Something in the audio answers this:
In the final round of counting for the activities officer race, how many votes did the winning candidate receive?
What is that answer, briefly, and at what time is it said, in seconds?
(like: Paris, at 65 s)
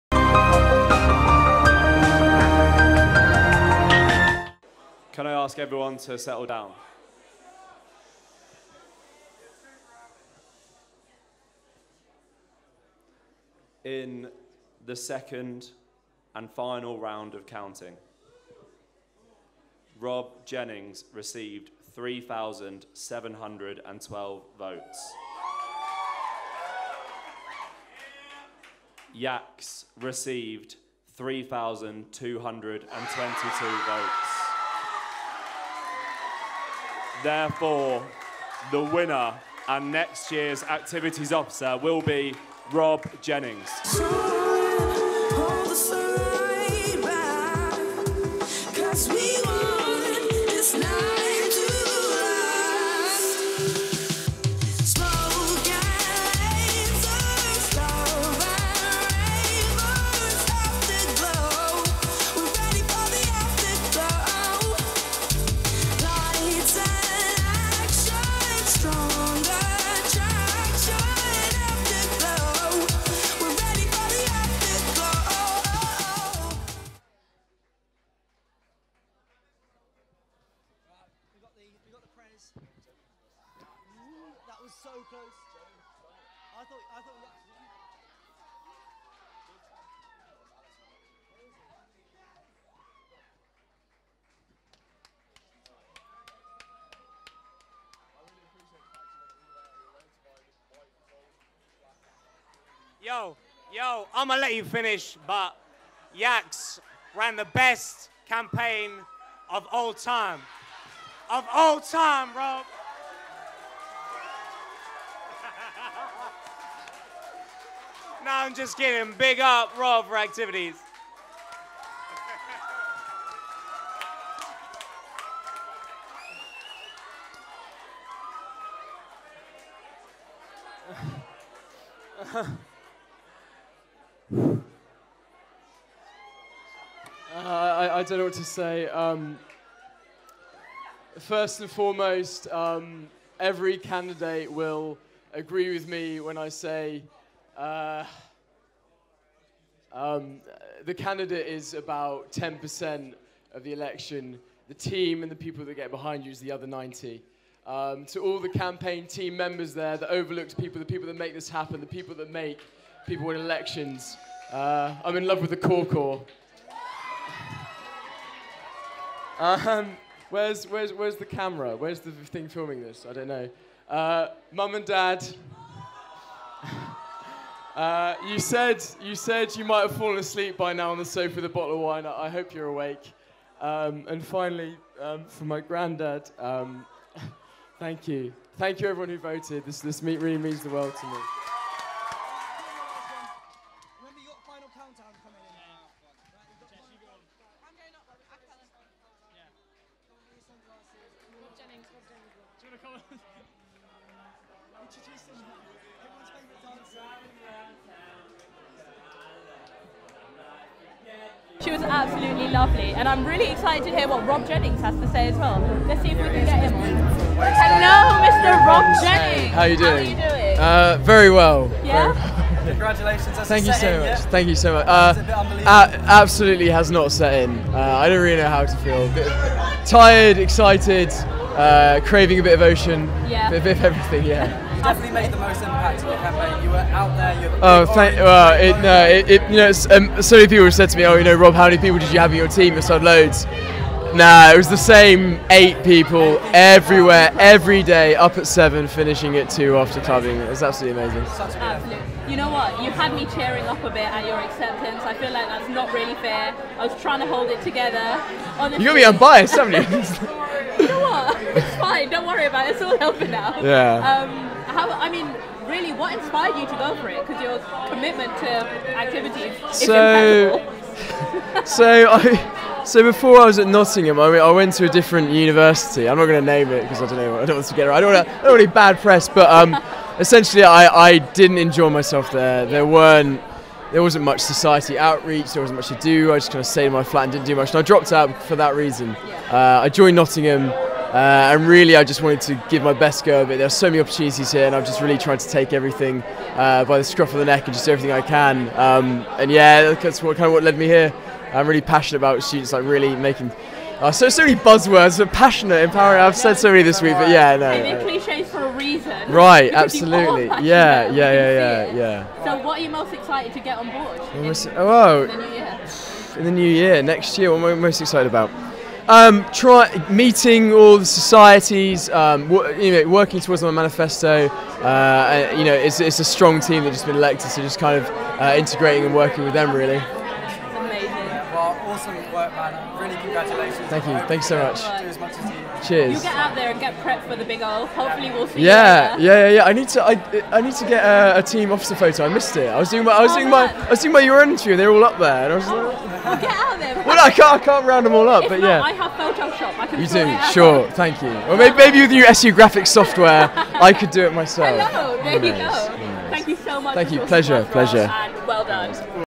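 3,712, at 21 s.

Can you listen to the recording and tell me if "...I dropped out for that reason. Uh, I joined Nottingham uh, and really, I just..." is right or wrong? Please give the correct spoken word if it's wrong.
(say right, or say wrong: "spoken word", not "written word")
right.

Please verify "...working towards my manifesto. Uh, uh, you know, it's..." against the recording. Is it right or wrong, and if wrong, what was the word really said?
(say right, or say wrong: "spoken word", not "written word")
right.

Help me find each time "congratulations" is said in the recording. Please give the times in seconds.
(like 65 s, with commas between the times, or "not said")
222 s, 333 s.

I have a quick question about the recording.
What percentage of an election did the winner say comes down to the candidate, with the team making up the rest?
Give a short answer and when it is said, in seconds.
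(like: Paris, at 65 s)
10%, at 152 s.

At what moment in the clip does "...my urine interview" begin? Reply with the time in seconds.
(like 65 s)
344 s.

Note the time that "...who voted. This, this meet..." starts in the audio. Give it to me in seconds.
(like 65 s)
189 s.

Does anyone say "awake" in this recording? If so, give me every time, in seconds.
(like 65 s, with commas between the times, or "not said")
182 s.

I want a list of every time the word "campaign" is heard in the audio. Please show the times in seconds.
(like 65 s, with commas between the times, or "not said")
108 s, 158 s, 236 s.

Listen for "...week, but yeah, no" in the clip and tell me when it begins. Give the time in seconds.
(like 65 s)
307 s.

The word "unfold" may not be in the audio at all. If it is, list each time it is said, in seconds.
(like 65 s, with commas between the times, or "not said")
not said.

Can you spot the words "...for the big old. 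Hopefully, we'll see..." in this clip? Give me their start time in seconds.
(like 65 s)
337 s.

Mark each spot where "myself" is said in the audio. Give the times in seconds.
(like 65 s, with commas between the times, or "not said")
281 s, 354 s.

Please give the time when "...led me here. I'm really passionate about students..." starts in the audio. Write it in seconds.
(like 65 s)
300 s.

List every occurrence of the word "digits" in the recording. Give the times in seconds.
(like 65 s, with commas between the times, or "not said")
not said.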